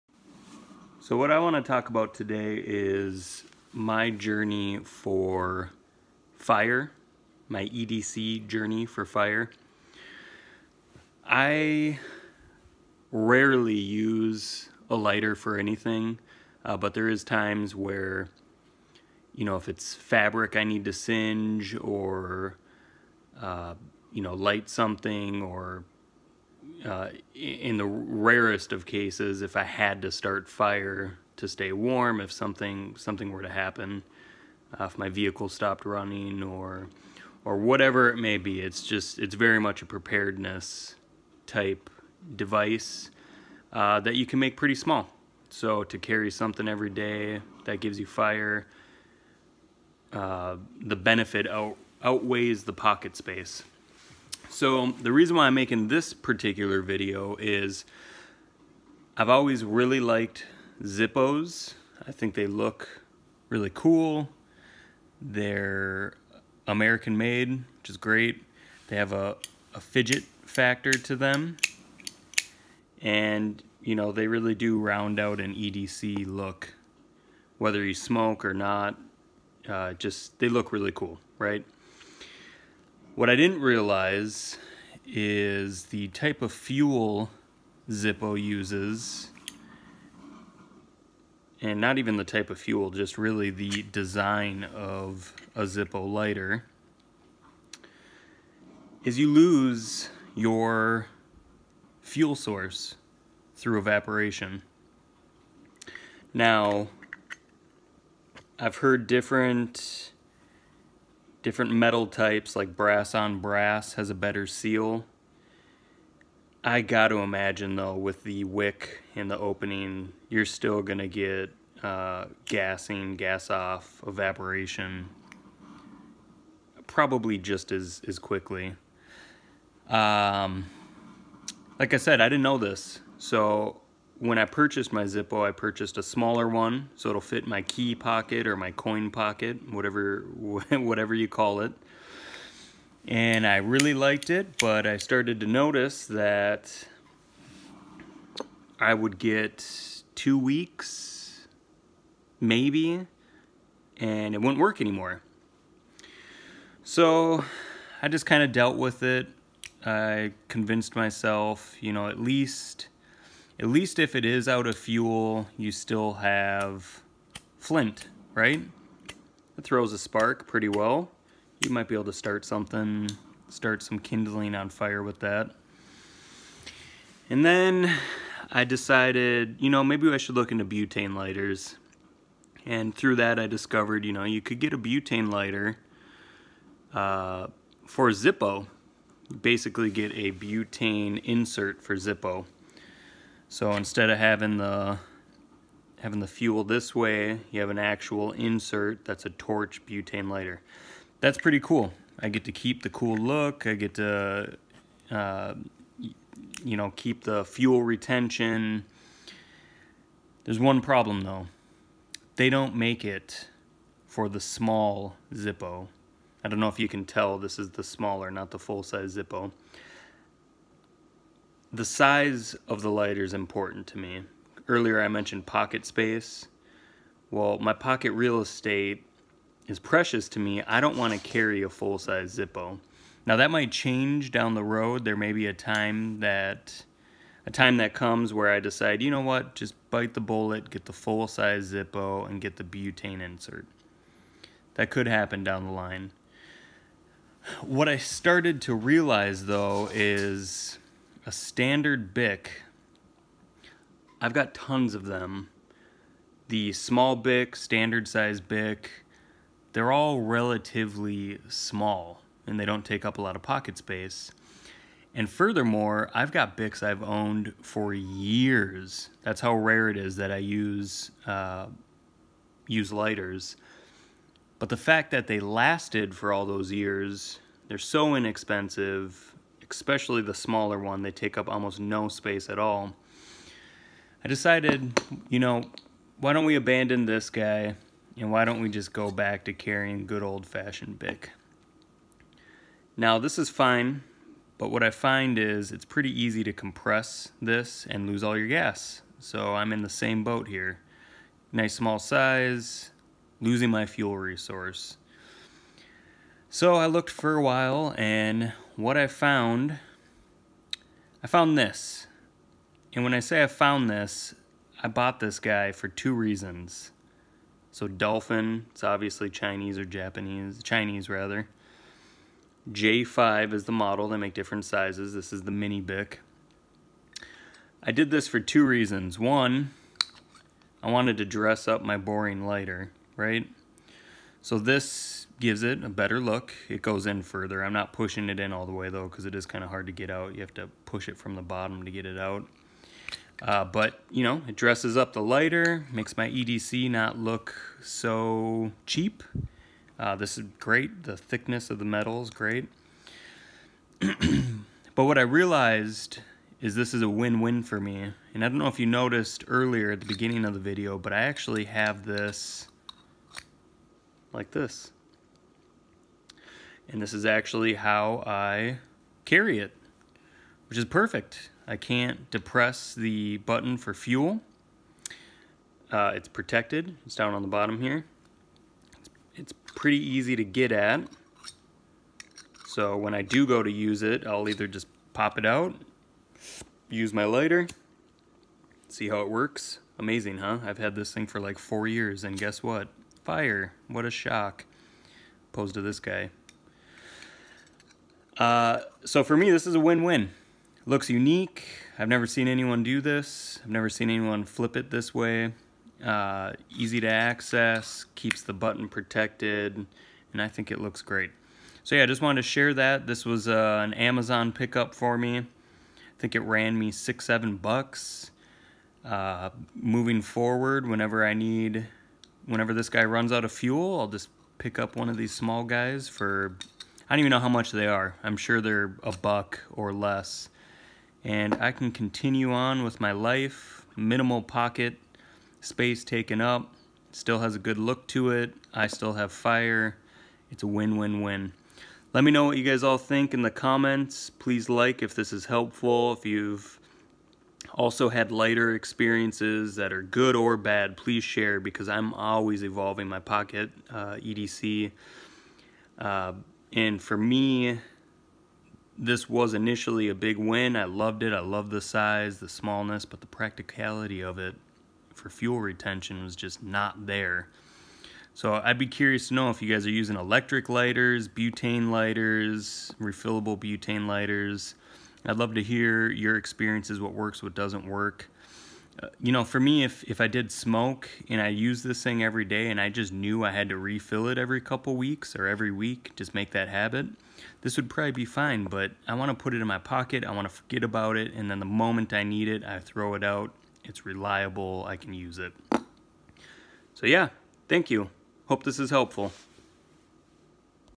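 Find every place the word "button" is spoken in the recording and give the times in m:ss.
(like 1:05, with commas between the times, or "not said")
6:13, 6:48.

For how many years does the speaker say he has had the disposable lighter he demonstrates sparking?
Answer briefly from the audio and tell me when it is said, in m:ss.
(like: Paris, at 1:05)
4 years, at 6:31.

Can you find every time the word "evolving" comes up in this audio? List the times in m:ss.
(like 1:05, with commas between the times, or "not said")
7:32.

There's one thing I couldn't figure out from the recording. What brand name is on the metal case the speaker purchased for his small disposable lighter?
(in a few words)
Dolphin.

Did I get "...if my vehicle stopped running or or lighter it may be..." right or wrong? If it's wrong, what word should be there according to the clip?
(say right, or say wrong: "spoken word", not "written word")
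wrong: "whatever", not "lighter".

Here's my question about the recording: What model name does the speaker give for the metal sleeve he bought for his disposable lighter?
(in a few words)
J5.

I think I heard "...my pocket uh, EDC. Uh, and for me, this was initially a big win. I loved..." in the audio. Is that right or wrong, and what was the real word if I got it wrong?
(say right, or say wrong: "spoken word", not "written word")
right.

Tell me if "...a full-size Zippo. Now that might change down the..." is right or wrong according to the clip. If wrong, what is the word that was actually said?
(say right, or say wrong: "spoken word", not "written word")
right.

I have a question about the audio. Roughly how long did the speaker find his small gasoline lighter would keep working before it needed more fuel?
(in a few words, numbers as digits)
2 weeks.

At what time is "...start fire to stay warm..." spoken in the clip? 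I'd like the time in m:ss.
0:30.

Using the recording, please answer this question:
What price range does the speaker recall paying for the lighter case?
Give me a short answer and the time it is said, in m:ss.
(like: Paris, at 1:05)
6 to 7 dollars, at 6:56.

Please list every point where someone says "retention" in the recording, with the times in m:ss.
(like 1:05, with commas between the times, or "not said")
3:27, 7:45.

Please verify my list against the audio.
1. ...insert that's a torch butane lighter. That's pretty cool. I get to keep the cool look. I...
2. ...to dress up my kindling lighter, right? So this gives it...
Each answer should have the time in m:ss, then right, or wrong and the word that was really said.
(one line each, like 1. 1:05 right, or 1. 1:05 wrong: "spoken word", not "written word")
1. 3:18 right
2. 5:31 wrong: "boring", not "kindling".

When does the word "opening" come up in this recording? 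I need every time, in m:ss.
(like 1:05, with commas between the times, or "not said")
1:59.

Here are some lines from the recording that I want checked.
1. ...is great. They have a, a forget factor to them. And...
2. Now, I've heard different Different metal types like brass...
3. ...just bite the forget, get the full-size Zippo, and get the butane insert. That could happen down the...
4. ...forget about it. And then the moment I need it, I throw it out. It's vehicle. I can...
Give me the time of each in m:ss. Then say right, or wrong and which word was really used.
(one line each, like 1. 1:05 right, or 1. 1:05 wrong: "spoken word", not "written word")
1. 1:07 wrong: "fidget", not "forget"
2. 1:46 right
3. 3:59 wrong: "bullet", not "forget"
4. 8:10 wrong: "reliable", not "vehicle".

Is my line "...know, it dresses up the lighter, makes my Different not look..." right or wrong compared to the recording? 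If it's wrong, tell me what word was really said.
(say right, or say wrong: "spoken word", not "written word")
wrong: "EDC", not "Different".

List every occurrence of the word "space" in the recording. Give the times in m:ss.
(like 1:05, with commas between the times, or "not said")
0:53, 3:45, 4:23, 4:42, 7:15.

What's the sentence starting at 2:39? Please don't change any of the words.
I convinced myself, you know, at least at least if it is out of fuel, you still have flint, right?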